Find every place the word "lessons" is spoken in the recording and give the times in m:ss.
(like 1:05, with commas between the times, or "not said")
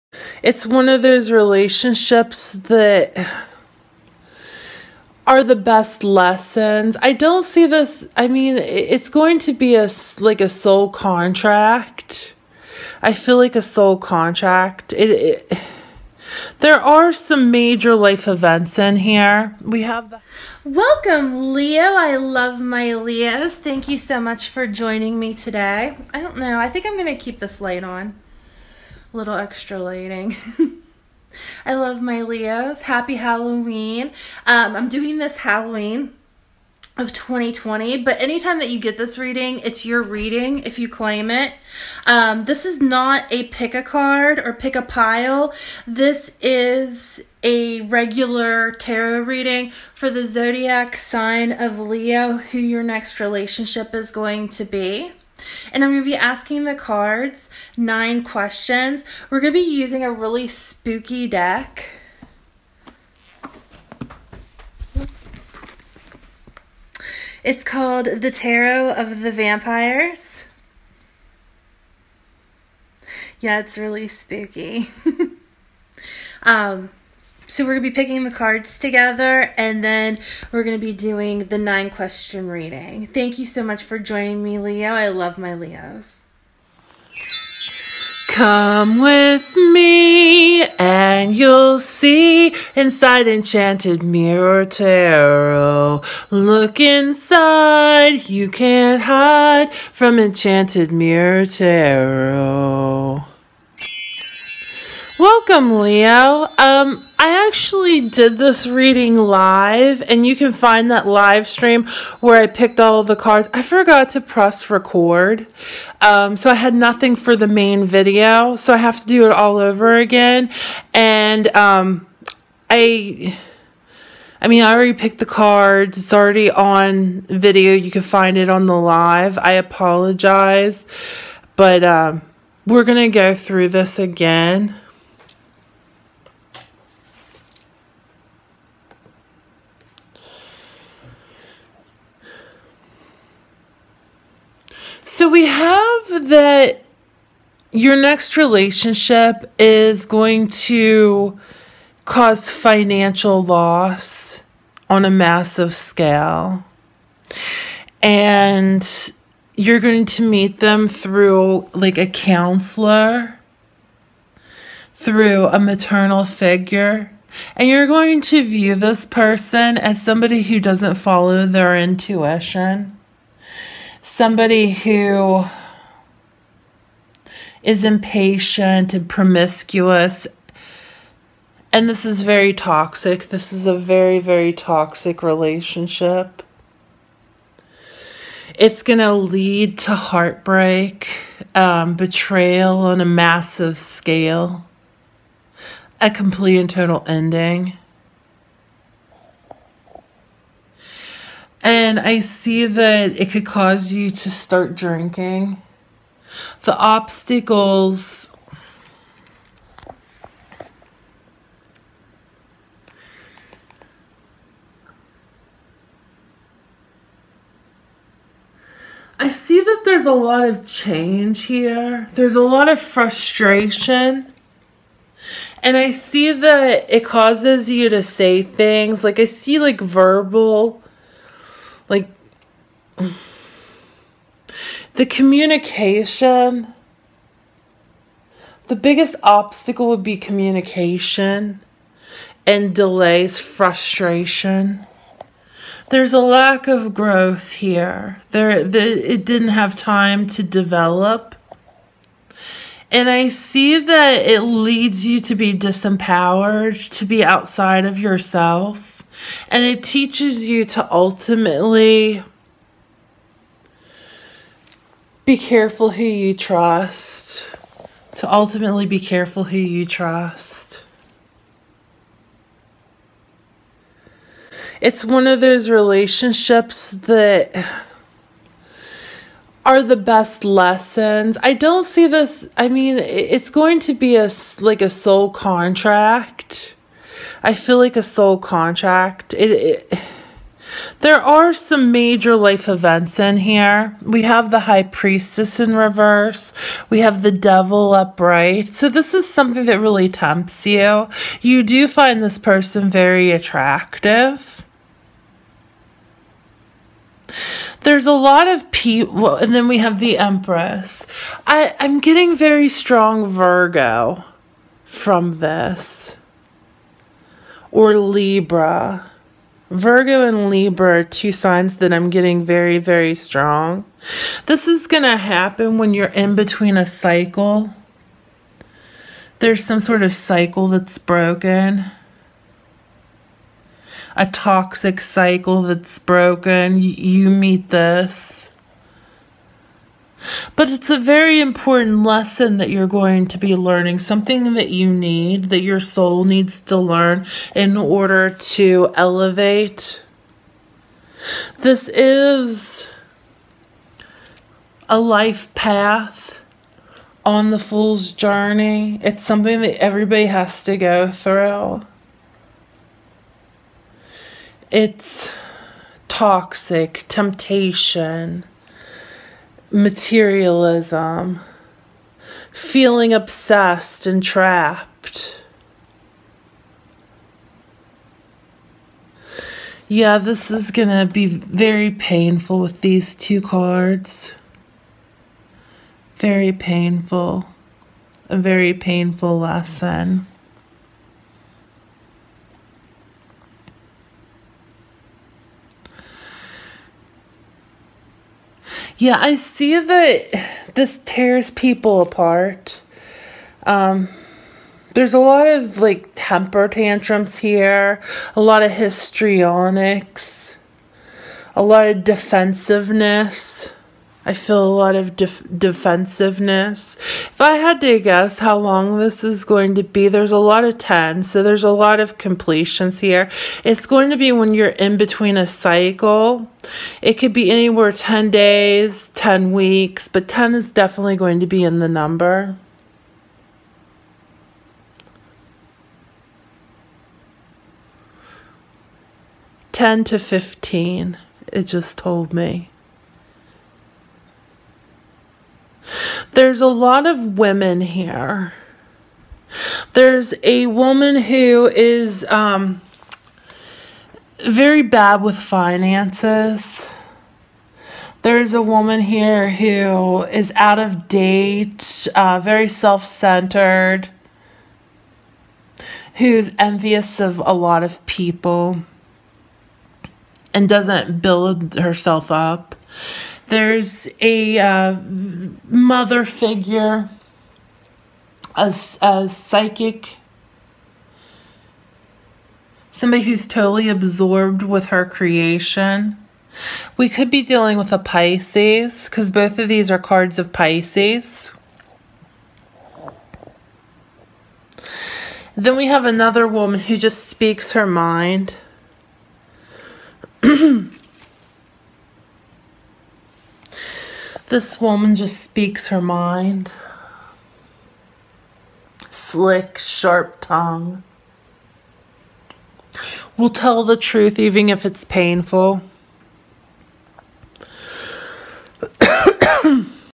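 0:06, 4:40, 5:42, 6:29.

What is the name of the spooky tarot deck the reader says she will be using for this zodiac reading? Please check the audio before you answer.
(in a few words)
The Tarot of the Vampyres.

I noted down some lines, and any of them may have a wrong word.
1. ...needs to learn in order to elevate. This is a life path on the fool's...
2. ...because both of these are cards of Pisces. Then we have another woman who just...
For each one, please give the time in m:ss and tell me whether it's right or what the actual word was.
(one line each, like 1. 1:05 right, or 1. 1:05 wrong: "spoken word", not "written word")
1. 5:46 right
2. 8:09 right.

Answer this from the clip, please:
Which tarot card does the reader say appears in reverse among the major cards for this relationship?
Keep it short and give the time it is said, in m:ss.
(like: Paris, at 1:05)
High Priestess, at 4:54.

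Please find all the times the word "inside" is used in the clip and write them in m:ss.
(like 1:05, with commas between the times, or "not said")
1:32, 1:36.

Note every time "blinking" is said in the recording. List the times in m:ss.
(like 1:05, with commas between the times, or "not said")
not said.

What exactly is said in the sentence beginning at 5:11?
I, I'm getting very strong Virgo from this or Libra.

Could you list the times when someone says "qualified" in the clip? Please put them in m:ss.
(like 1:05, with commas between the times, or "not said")
not said.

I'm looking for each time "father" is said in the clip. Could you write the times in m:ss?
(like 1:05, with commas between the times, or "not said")
not said.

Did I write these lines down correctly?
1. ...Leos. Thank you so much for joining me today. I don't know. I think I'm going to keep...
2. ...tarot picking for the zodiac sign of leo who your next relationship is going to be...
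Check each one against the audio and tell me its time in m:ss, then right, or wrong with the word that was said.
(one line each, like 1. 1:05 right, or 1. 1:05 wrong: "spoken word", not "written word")
1. 0:22 right
2. 0:48 wrong: "reading", not "picking".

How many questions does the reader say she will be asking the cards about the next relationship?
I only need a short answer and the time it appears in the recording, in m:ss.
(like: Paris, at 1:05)
9, at 0:57.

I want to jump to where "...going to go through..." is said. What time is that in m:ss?
2:12.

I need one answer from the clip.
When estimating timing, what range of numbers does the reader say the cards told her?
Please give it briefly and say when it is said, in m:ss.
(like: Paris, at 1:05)
10 to 15, at 7:19.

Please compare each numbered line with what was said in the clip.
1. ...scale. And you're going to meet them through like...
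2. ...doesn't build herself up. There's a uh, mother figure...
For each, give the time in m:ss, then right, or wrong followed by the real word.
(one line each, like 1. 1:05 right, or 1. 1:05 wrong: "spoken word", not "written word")
1. 2:35 right
2. 7:50 right.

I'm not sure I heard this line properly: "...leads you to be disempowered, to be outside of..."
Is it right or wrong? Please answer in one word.
right.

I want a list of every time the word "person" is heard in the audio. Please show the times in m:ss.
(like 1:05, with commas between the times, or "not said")
2:49, 5:02.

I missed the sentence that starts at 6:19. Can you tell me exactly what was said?
Yeah, this is going to be very painful with these two cards.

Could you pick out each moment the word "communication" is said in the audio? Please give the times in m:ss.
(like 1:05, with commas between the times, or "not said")
3:55, 4:00.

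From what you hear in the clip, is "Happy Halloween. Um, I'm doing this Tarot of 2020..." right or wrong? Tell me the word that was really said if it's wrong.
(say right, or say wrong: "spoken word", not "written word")
wrong: "Halloween", not "Tarot".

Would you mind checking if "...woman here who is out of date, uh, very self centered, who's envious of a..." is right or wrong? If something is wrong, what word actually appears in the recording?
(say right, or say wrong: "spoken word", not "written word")
right.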